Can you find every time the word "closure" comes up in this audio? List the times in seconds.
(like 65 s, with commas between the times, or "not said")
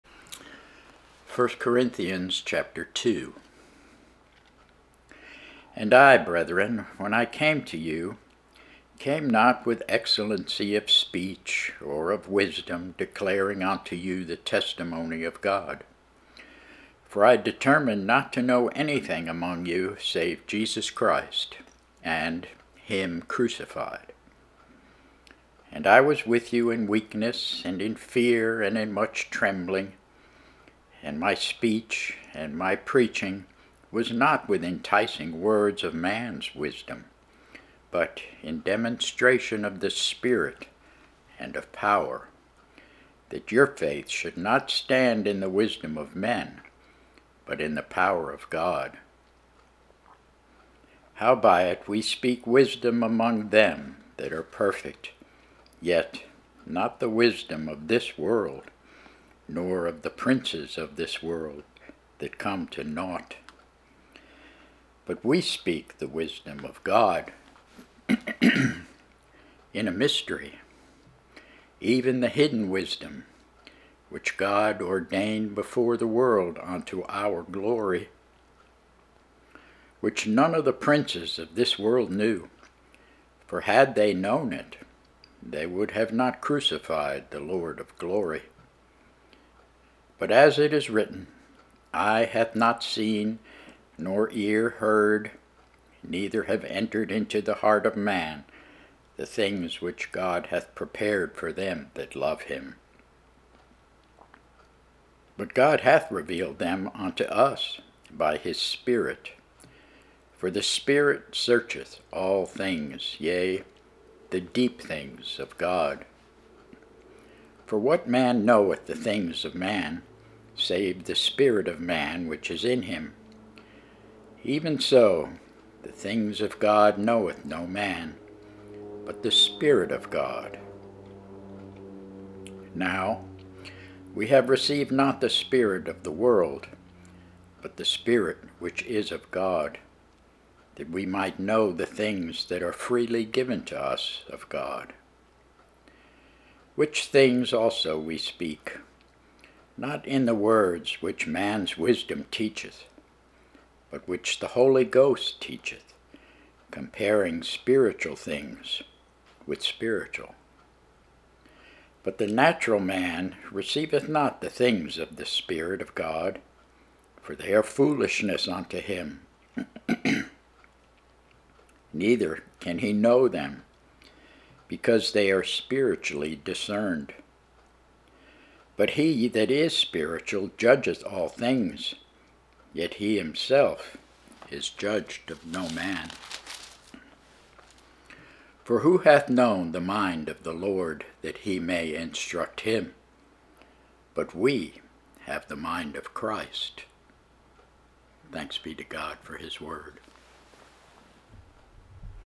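not said.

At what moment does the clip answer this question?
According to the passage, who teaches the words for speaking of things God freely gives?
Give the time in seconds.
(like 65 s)
154 s.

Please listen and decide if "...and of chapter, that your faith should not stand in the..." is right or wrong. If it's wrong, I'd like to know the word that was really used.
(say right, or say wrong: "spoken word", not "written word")
wrong: "power", not "chapter".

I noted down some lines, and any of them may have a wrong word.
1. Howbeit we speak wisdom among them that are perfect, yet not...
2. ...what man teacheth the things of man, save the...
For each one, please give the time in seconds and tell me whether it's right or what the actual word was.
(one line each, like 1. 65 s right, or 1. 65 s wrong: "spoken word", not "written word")
1. 51 s right
2. 117 s wrong: "knoweth", not "teacheth".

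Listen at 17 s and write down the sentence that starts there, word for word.
For I determined not to know anything among you save Jesus Christ, and him crucified.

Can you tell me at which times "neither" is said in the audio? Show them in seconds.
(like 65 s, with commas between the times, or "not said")
96 s, 171 s.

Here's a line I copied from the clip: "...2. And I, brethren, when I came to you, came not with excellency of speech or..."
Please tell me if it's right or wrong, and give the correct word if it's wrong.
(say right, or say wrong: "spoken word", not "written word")
right.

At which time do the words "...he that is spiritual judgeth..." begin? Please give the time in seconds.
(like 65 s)
179 s.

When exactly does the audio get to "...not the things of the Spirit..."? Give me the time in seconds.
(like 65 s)
164 s.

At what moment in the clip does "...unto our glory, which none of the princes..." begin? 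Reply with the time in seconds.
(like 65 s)
76 s.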